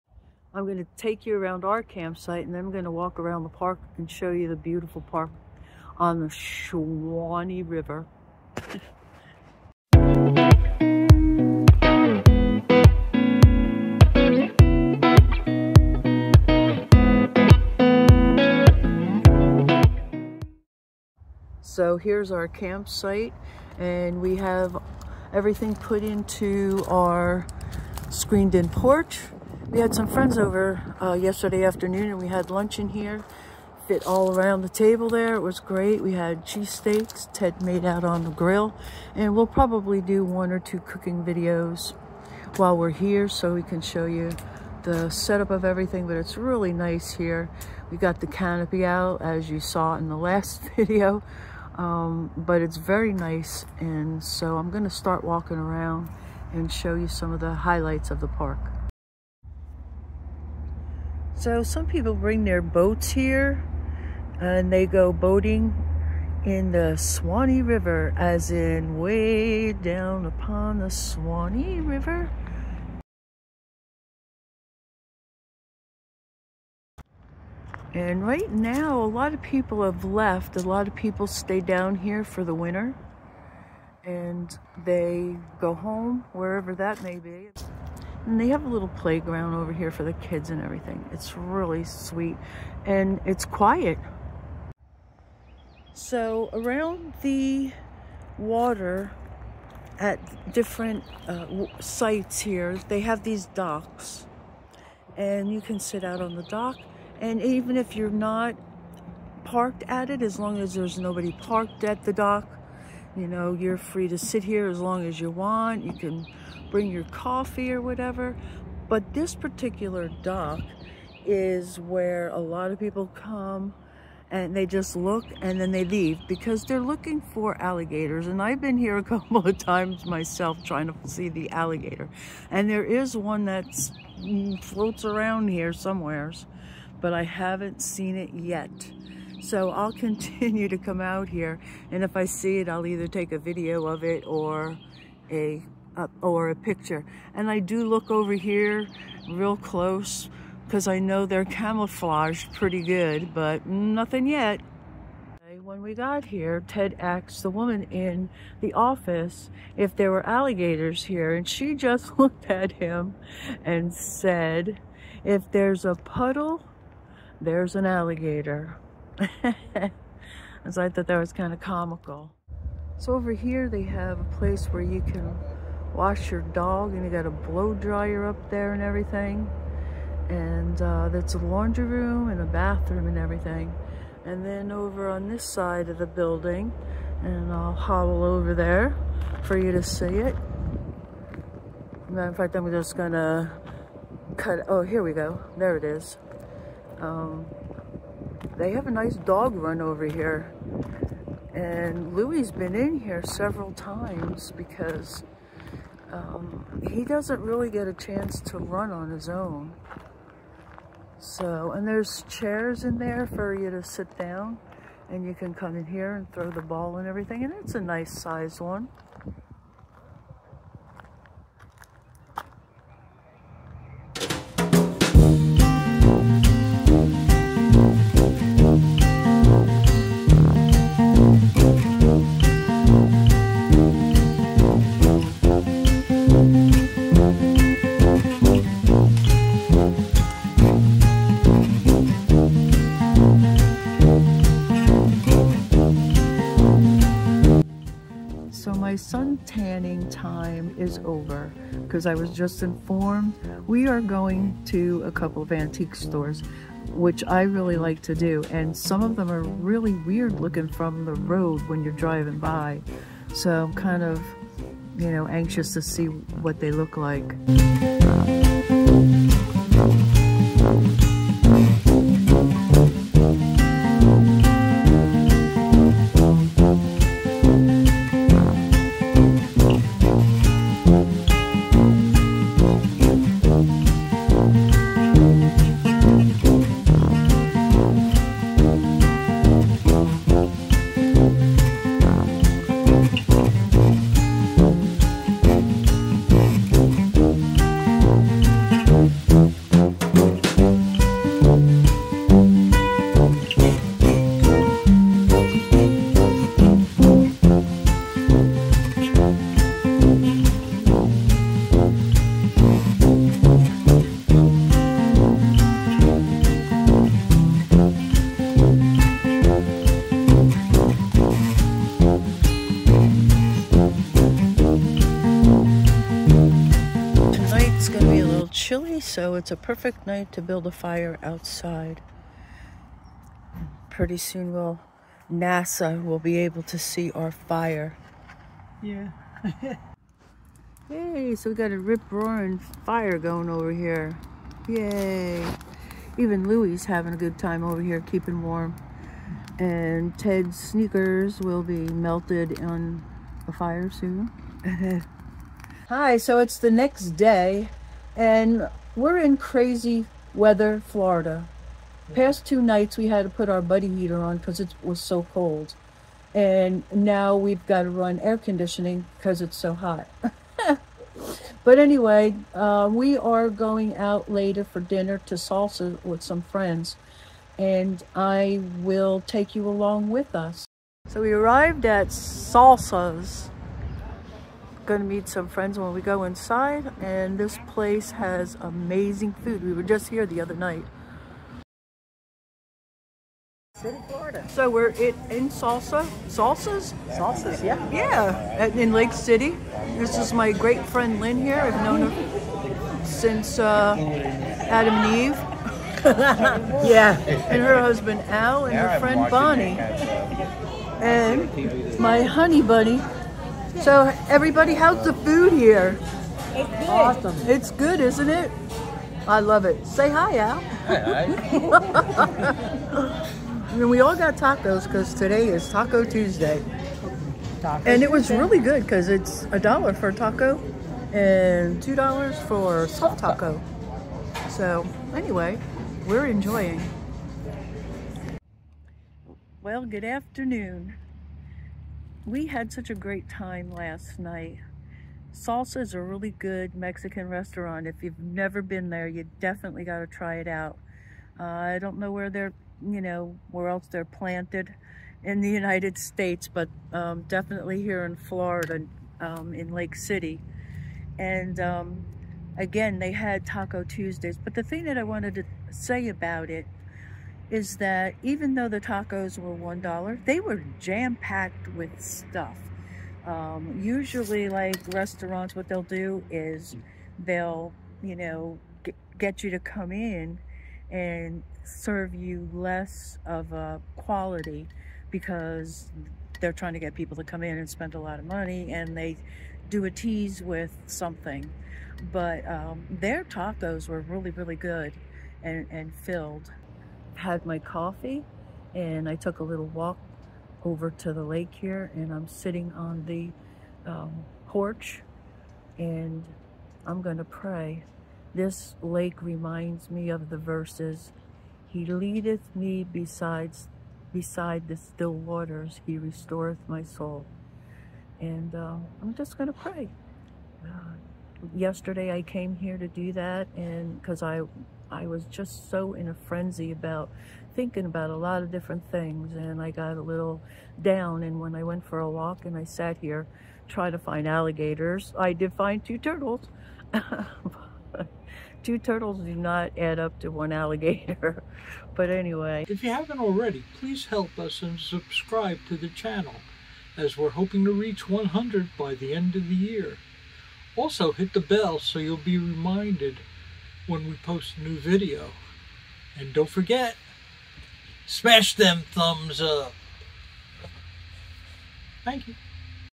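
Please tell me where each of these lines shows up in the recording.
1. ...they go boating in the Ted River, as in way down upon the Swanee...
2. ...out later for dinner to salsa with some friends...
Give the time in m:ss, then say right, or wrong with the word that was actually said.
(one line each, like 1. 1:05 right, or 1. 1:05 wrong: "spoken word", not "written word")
1. 1:04 wrong: "Suwannee", not "Ted"
2. 6:13 right.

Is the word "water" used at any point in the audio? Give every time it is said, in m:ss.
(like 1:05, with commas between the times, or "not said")
1:38, 8:35.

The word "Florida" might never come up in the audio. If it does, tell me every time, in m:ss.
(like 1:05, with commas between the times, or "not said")
6:00, 6:34, 7:38.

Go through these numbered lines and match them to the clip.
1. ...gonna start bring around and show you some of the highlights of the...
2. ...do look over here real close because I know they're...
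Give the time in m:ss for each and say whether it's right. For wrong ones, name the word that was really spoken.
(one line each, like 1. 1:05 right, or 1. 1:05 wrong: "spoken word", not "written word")
1. 0:54 wrong: "walking", not "bring"
2. 2:27 right.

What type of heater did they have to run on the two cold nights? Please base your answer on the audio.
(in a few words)
Buddy heater.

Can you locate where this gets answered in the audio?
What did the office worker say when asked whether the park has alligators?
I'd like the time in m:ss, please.
2:45.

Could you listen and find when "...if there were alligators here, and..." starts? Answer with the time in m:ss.
2:39.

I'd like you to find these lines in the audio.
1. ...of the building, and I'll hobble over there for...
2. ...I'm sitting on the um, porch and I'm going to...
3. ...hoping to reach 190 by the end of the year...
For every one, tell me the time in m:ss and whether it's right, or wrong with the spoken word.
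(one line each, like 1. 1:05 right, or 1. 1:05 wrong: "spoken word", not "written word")
1. 3:05 right
2. 8:22 right
3. 9:07 wrong: "100", not "190".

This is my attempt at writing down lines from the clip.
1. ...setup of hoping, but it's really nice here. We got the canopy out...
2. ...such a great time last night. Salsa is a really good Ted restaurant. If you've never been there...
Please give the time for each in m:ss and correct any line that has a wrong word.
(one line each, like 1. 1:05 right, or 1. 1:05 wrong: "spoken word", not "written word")
1. 0:45 wrong: "everything", not "hoping"
2. 7:22 wrong: "Mexican", not "Ted".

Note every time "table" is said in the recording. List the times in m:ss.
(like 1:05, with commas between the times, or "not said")
0:34.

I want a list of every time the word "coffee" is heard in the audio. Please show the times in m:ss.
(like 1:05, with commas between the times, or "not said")
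1:57, 8:17.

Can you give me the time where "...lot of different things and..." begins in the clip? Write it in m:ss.
8:48.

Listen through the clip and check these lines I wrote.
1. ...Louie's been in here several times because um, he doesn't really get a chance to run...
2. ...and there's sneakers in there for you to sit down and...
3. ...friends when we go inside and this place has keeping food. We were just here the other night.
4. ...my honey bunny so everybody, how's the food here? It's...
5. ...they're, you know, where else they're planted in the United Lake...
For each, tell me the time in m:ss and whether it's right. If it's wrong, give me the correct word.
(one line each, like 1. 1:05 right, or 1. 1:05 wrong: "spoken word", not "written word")
1. 3:22 right
2. 3:31 wrong: "chairs", not "sneakers"
3. 6:25 wrong: "amazing", not "keeping"
4. 6:51 right
5. 7:32 wrong: "States", not "Lake".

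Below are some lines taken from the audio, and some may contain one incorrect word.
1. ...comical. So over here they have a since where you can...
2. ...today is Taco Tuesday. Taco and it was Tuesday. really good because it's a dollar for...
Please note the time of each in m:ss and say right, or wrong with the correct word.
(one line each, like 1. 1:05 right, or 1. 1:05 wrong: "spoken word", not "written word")
1. 2:51 wrong: "place", not "since"
2. 7:05 right.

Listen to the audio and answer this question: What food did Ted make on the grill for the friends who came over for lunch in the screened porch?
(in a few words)
Cheesesteaks.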